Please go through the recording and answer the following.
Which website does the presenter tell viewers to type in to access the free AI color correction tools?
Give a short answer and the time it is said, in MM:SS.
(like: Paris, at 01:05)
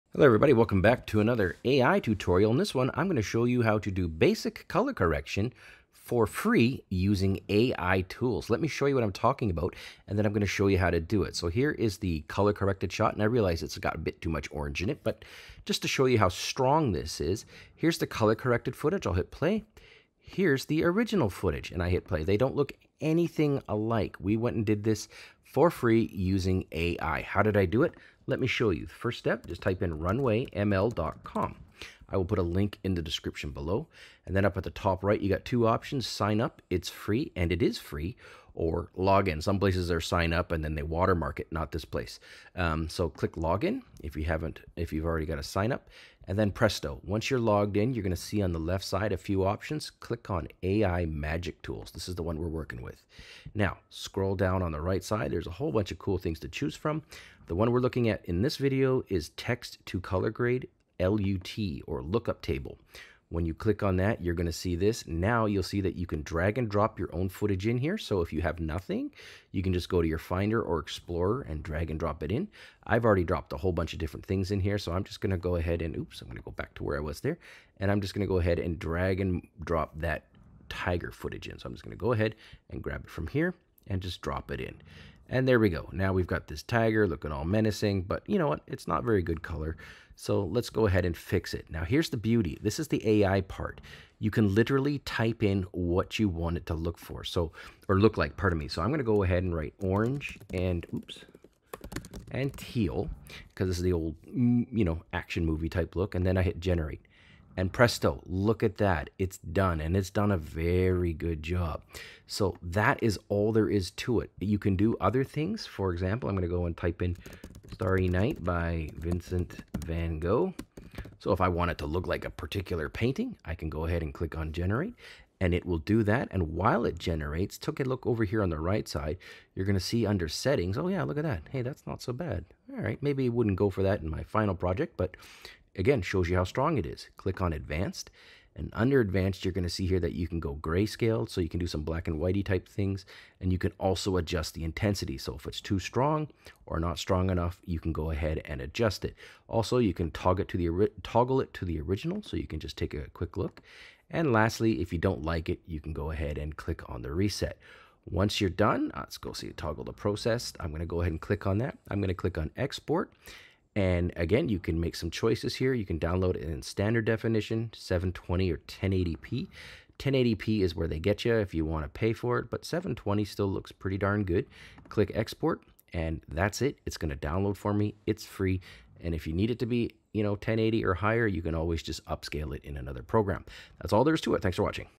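runwayml.com, at 00:29.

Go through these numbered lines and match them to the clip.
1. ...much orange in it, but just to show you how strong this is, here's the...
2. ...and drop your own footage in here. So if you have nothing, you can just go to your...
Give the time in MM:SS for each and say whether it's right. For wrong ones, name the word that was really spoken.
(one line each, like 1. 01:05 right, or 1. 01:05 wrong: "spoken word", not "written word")
1. 00:14 right
2. 01:06 right.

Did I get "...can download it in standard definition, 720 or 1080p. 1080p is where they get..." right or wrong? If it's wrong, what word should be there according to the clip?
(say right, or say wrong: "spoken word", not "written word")
right.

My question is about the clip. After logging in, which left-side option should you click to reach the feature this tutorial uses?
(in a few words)
AI Magic Tools.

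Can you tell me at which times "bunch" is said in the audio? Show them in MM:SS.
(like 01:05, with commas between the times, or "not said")
00:55, 01:13.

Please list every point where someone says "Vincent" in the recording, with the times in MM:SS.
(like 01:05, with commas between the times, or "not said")
01:58.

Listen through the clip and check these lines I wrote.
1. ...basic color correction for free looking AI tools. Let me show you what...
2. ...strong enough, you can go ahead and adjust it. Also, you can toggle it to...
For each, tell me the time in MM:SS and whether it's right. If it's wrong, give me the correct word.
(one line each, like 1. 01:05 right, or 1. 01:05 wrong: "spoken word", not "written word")
1. 00:04 wrong: "using", not "looking"
2. 02:26 right.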